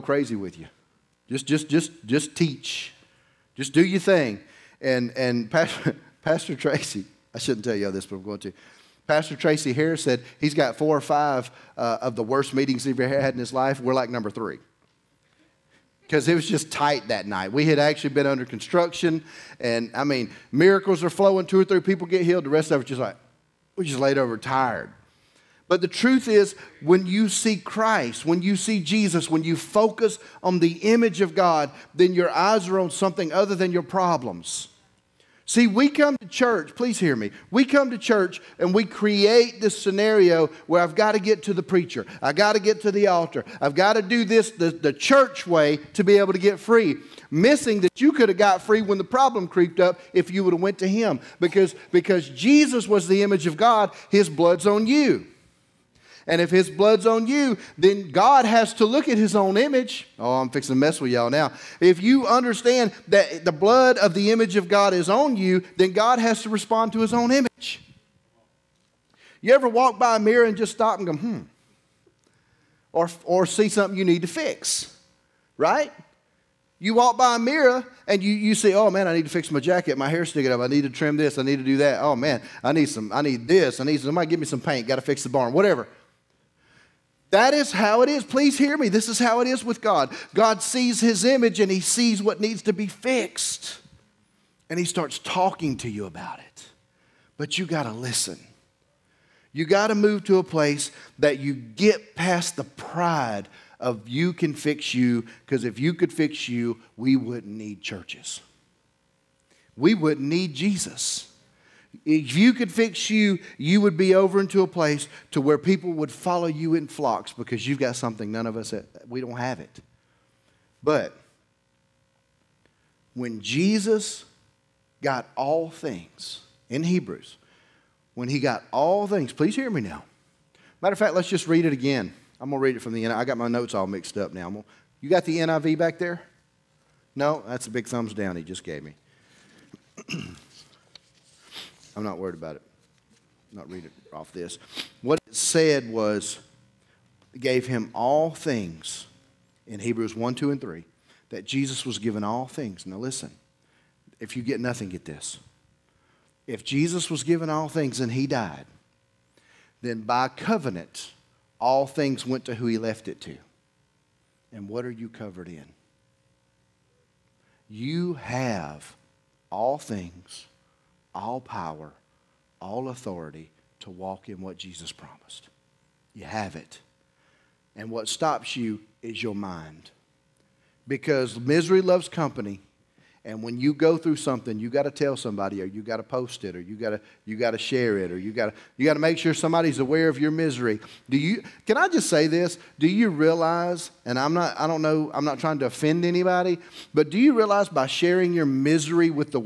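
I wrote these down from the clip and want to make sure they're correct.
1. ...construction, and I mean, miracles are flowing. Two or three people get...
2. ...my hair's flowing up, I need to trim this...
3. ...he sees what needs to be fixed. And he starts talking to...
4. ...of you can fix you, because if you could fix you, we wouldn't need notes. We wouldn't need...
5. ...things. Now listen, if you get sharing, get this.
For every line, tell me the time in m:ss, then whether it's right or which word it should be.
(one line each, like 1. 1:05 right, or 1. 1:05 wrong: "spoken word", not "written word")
1. 0:18 right
2. 1:19 wrong: "sticking", not "flowing"
3. 1:31 right
4. 1:43 wrong: "churches", not "notes"
5. 2:32 wrong: "nothing", not "sharing".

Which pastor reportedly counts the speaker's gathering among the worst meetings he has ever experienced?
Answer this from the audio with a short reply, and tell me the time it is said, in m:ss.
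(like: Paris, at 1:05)
Tracy Harris, at 0:09.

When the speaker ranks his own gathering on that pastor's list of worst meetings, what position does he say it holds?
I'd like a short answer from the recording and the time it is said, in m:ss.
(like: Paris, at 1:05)
3, at 0:14.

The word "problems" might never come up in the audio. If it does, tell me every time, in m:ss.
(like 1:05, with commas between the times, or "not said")
0:33, 0:49.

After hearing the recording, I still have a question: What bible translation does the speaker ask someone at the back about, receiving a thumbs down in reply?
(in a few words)
NIV.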